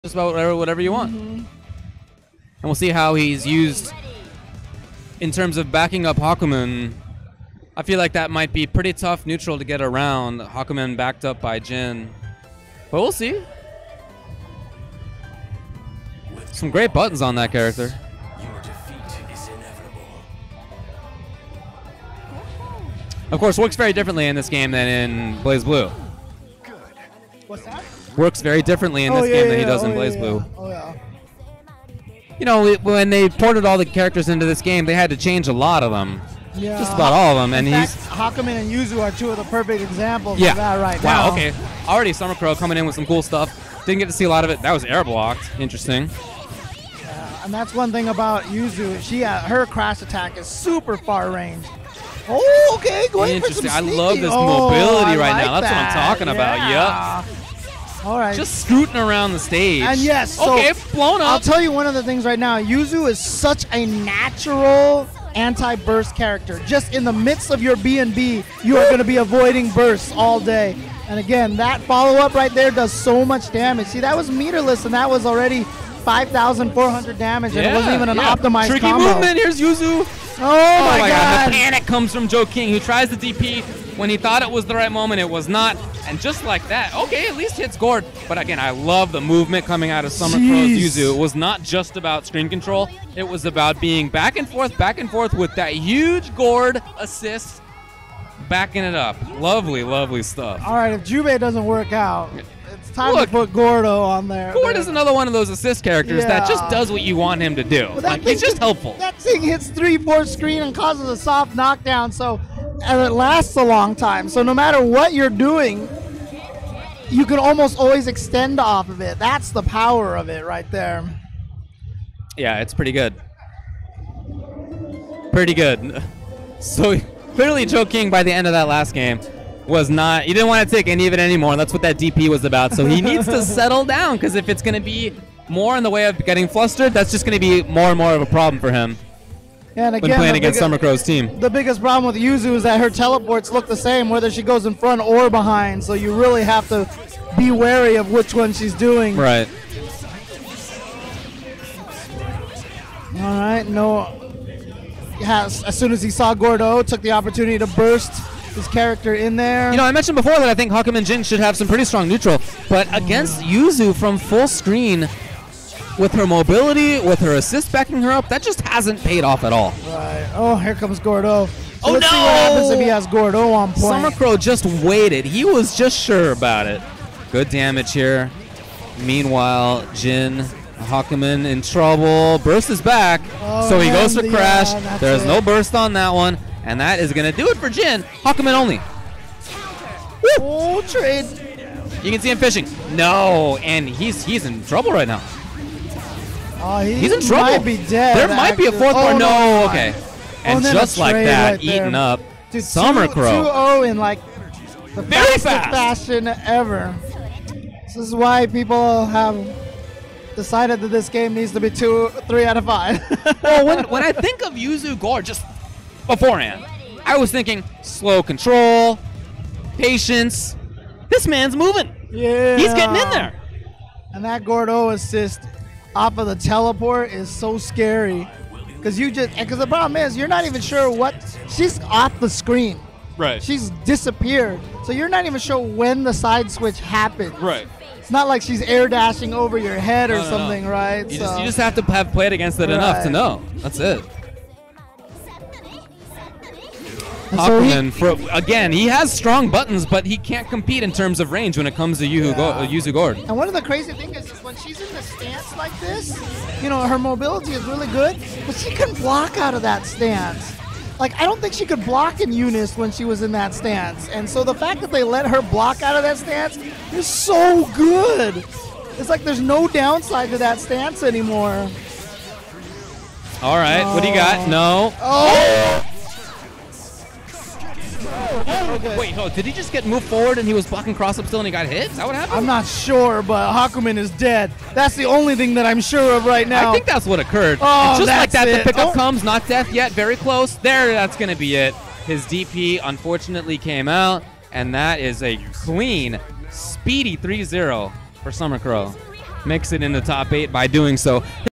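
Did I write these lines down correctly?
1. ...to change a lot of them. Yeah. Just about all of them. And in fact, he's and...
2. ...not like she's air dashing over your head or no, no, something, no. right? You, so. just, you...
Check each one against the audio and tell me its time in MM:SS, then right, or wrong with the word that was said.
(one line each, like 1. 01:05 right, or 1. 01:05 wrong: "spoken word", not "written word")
1. 00:35 right
2. 03:58 right.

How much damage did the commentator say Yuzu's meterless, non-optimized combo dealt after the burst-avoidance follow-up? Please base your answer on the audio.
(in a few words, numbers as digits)
5,400.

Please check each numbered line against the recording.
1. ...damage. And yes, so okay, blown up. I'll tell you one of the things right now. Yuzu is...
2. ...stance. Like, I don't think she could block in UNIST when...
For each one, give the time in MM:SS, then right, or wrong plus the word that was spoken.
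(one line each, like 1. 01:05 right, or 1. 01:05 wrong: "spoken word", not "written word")
1. 00:59 wrong: "stage", not "damage"
2. 04:19 right.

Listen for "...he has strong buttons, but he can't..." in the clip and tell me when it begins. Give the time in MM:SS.
04:08.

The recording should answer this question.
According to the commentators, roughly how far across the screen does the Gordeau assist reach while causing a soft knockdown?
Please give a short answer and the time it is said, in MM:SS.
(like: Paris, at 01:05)
3/4 screen, at 01:49.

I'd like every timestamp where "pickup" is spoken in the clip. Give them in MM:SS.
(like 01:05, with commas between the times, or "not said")
04:48.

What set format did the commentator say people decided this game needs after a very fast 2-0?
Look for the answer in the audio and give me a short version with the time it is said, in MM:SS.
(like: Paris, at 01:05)
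three out of five, at 03:32.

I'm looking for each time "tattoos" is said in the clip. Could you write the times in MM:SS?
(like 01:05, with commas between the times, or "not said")
not said.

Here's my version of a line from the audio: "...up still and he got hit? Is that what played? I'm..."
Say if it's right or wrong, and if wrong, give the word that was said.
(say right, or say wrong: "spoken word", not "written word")
wrong: "happened", not "played".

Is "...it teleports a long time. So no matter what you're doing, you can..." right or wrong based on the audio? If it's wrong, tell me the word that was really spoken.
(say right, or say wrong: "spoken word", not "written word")
wrong: "lasts", not "teleports".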